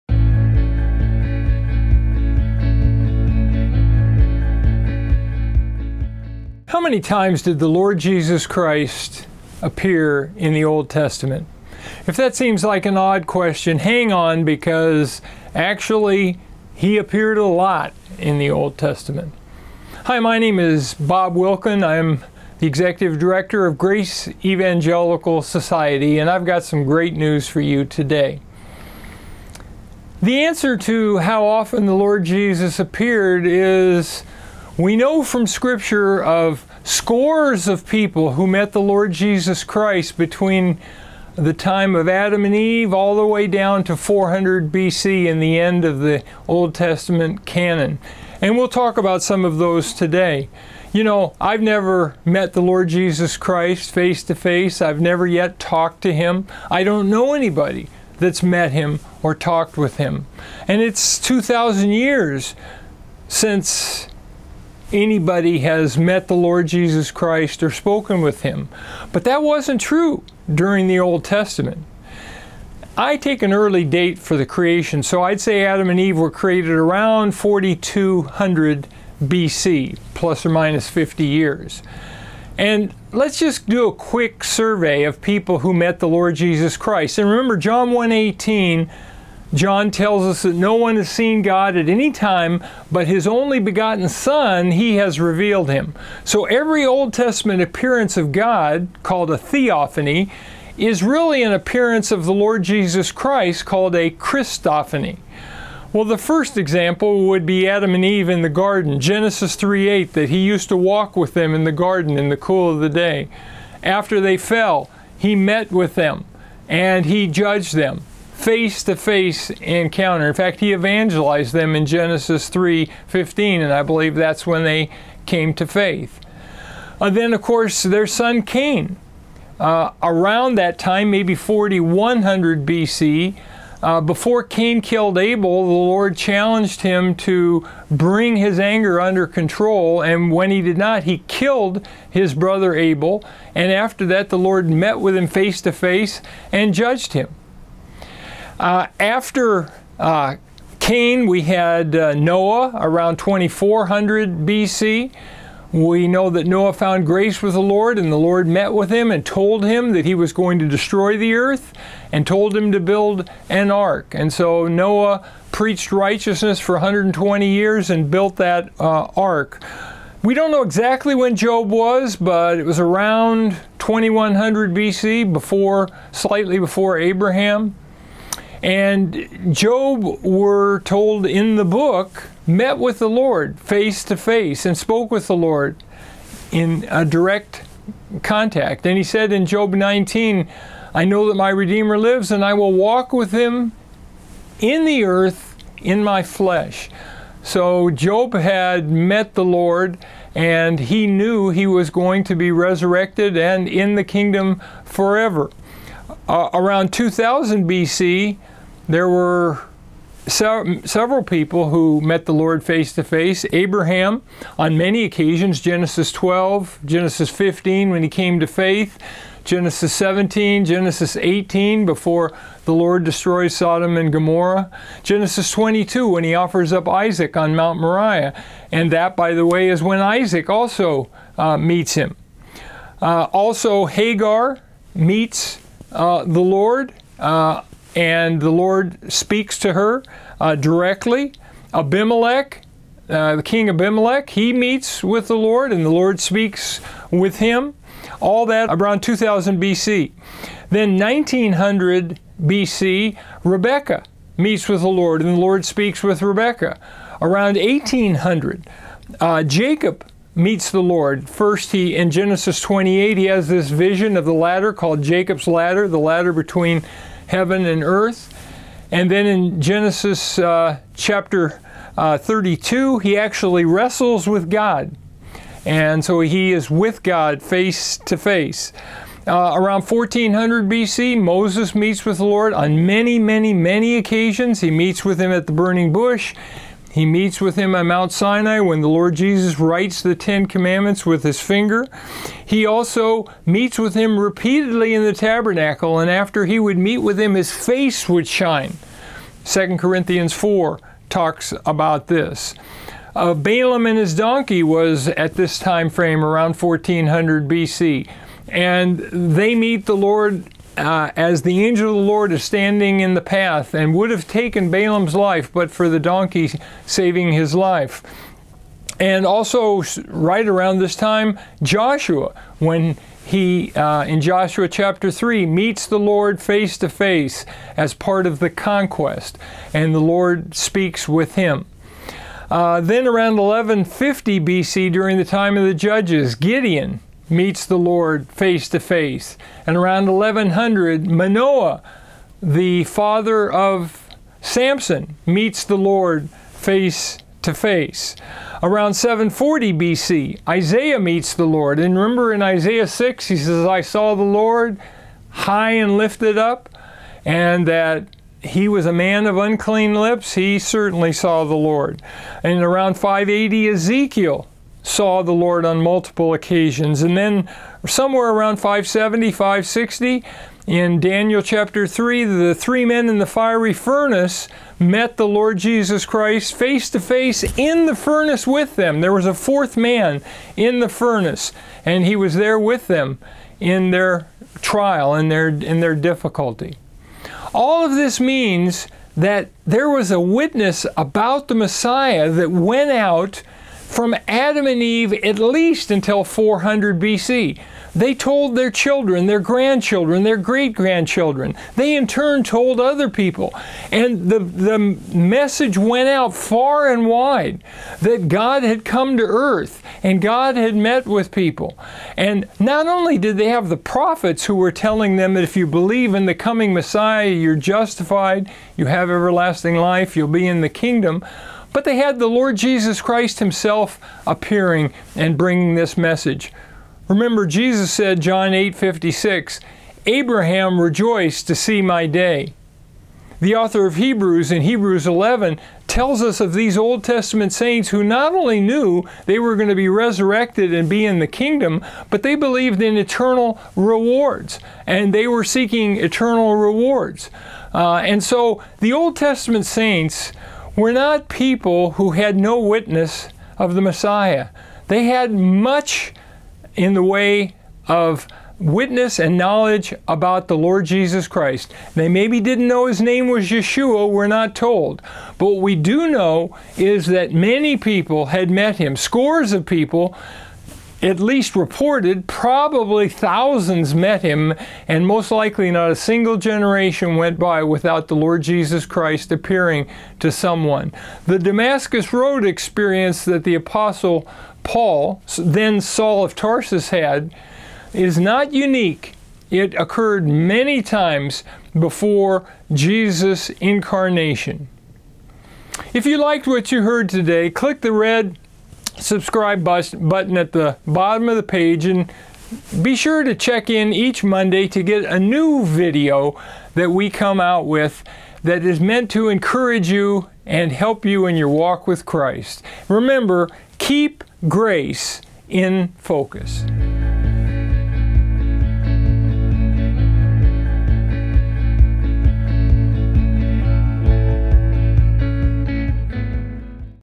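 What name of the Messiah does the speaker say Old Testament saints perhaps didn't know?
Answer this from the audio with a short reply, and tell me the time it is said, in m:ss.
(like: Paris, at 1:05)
Yeshua, at 7:43.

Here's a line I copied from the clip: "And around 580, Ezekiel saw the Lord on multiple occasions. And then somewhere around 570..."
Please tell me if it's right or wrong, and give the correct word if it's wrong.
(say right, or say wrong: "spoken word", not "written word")
right.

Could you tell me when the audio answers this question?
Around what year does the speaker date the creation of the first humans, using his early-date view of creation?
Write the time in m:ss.
1:17.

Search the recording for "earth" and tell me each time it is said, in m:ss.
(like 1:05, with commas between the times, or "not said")
2:41, 3:15, 4:27, 6:49.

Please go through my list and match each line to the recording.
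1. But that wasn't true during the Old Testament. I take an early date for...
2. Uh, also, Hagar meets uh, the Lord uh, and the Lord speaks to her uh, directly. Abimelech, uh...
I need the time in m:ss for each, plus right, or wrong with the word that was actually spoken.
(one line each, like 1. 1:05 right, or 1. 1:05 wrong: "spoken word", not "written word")
1. 1:09 right
2. 3:53 right.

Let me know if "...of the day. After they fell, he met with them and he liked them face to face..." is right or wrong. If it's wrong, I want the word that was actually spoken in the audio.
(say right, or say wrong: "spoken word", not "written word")
wrong: "judged", not "liked".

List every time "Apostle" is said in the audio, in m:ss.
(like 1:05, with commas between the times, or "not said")
8:03.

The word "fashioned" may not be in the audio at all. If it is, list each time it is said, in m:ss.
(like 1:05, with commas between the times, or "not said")
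not said.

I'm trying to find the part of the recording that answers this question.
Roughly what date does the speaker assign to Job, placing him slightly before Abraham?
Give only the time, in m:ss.
2:53.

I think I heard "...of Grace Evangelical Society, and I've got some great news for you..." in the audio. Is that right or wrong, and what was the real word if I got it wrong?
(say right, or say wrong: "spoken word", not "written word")
right.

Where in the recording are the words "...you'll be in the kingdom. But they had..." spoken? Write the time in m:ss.
7:00.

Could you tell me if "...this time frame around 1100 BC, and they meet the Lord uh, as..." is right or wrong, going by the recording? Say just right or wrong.
wrong.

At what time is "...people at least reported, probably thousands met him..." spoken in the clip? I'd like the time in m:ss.
7:49.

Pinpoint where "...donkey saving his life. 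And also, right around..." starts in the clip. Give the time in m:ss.
5:15.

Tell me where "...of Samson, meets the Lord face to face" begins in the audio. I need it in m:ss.
5:43.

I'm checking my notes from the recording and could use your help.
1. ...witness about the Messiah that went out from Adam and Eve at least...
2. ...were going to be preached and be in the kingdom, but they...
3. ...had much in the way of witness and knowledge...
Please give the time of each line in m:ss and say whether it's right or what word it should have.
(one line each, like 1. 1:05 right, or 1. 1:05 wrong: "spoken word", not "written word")
1. 6:30 right
2. 7:19 wrong: "resurrected", not "preached"
3. 7:35 right.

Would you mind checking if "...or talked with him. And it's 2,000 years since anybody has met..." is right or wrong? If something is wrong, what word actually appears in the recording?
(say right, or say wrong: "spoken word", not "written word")
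right.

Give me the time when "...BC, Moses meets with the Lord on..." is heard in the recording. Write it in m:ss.
4:40.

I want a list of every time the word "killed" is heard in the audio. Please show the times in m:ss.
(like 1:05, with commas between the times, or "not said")
2:14, 2:21.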